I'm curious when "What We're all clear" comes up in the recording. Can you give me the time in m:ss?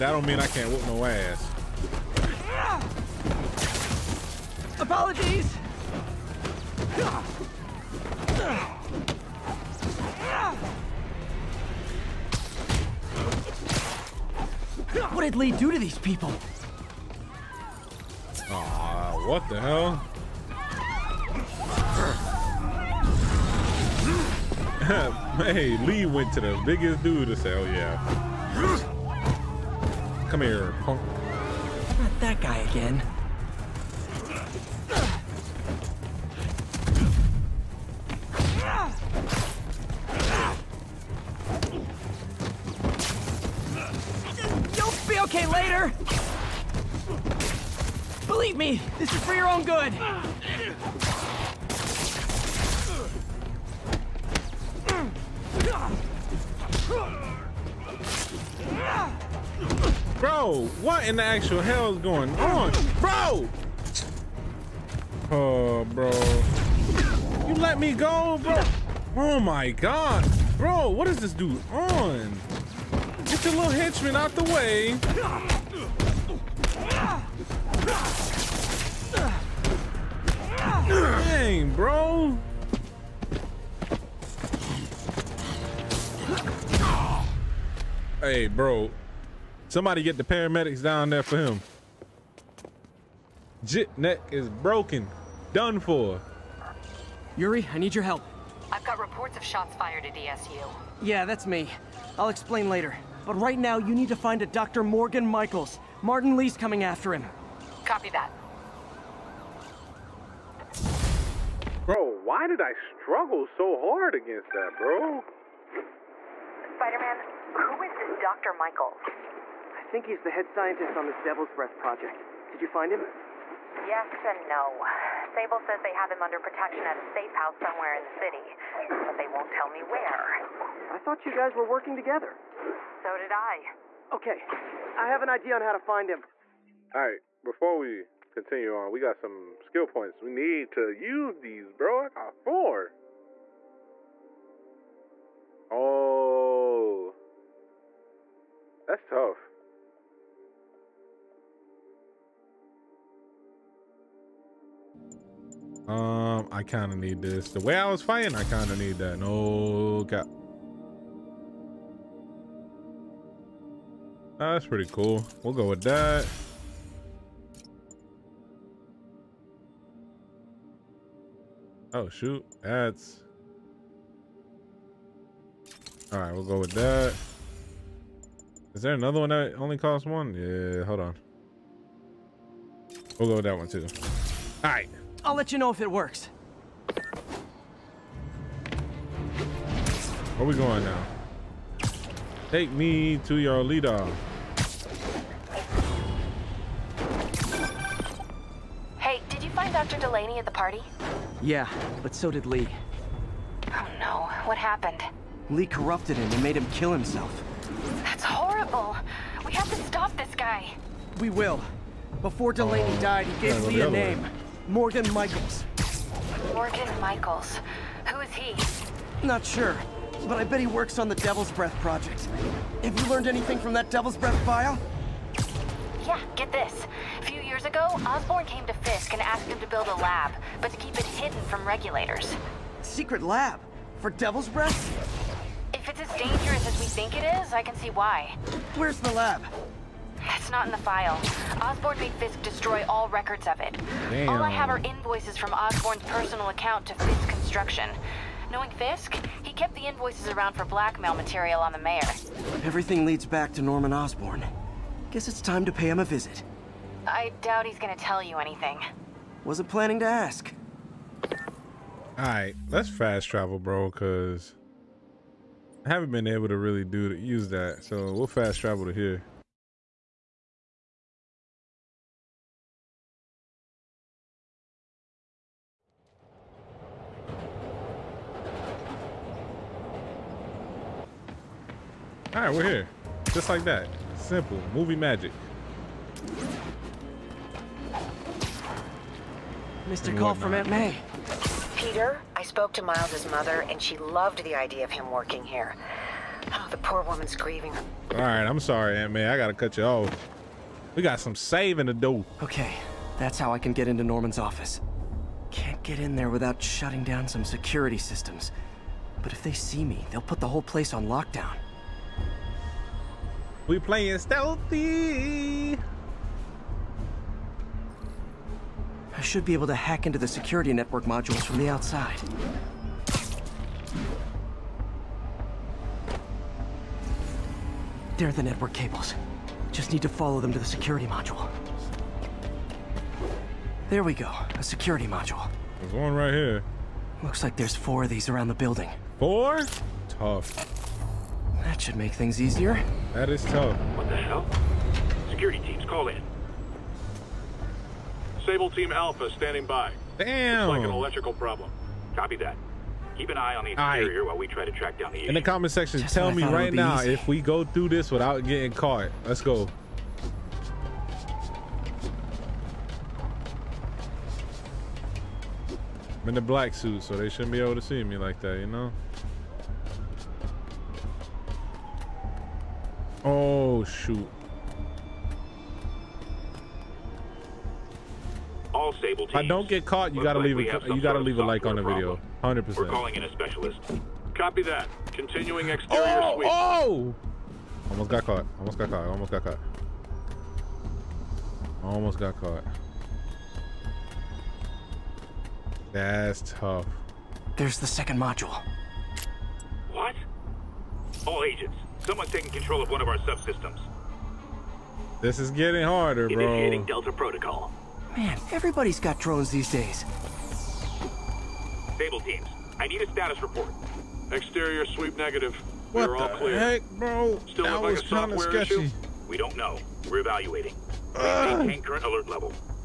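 6:55.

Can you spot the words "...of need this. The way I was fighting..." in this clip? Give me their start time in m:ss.
2:36.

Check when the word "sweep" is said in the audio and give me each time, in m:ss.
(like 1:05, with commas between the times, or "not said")
6:26, 6:54.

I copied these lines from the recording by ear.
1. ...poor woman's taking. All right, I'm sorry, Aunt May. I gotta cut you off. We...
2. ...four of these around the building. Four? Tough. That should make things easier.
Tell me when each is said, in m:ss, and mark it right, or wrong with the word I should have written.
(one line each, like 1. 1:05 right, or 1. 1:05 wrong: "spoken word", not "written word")
1. 4:56 wrong: "grieving", not "taking"
2. 5:37 right.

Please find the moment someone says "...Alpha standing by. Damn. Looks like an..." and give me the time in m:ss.
5:48.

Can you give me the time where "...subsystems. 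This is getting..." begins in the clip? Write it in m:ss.
6:43.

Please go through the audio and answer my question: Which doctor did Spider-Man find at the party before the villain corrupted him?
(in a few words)
Dr. Delaney.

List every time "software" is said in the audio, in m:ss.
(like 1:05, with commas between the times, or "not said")
6:58.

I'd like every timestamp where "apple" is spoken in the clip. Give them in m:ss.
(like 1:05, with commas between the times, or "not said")
not said.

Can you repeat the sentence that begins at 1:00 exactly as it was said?
what in the actual hell is going on?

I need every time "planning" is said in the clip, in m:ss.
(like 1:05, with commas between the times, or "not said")
4:19.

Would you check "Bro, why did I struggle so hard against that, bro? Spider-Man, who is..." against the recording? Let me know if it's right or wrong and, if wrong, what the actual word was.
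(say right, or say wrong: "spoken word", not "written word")
right.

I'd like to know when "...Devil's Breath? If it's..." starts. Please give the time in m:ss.
3:54.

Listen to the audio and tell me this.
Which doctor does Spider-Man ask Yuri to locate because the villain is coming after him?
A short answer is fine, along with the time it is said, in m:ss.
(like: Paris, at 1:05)
Dr. Morgan Michaels, at 1:44.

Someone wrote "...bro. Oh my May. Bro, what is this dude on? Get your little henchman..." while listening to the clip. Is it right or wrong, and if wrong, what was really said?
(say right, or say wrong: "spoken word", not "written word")
wrong: "God", not "May".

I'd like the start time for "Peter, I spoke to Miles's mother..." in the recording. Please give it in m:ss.
4:51.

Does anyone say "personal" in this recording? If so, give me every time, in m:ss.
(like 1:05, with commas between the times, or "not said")
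4:06.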